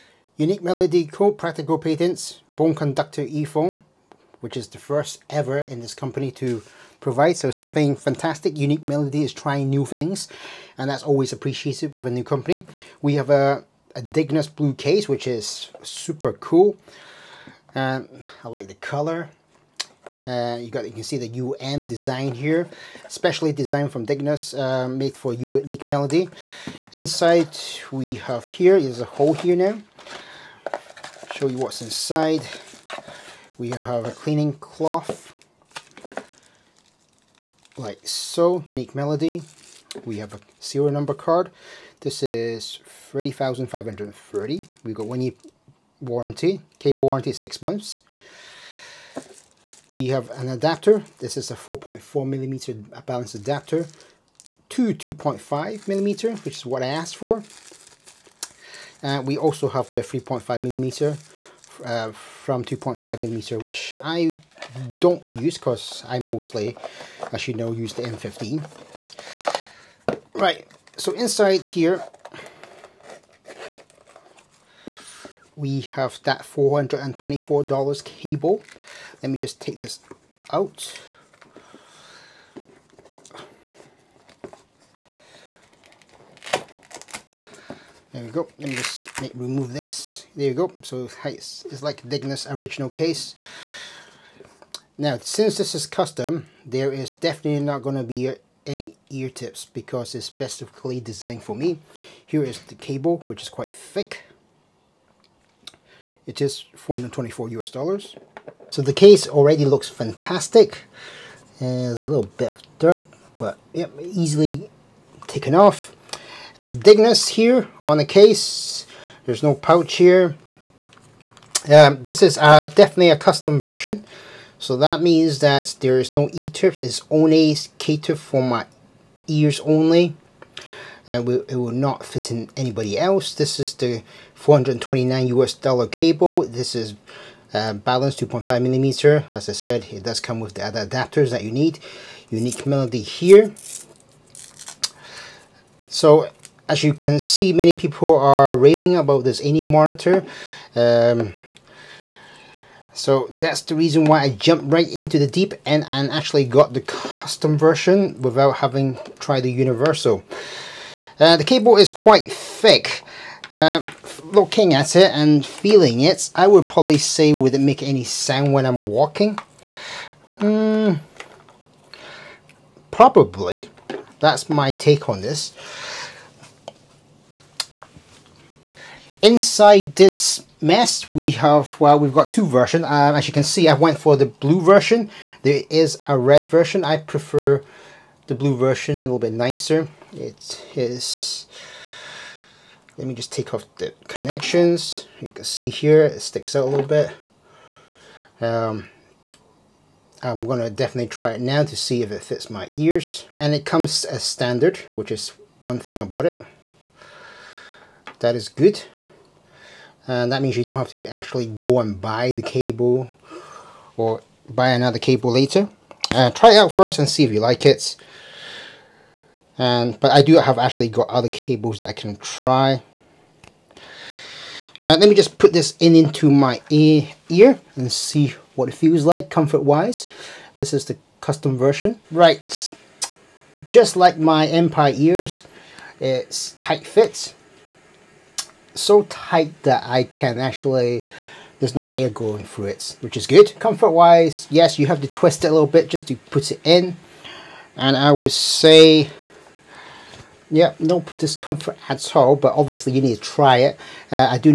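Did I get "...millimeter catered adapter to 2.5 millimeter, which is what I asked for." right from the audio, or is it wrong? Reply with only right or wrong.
wrong.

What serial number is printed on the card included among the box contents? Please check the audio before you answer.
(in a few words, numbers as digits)
30530.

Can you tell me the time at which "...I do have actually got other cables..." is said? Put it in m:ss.
3:40.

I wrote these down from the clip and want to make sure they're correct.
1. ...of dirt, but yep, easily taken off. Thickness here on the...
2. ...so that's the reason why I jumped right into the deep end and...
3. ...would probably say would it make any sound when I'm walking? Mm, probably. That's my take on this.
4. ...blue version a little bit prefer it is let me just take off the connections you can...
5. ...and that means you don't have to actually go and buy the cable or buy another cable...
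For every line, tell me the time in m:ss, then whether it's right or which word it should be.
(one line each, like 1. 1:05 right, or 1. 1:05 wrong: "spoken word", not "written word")
1. 1:52 right
2. 2:32 right
3. 2:46 right
4. 3:08 wrong: "nicer", not "prefer"
5. 3:30 right.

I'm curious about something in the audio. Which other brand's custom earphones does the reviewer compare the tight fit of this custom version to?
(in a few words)
Empire Ears.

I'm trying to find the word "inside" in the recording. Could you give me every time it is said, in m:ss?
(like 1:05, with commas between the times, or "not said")
0:26, 0:31, 1:11, 2:59.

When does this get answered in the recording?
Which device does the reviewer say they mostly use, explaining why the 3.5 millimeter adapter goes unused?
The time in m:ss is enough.
1:08.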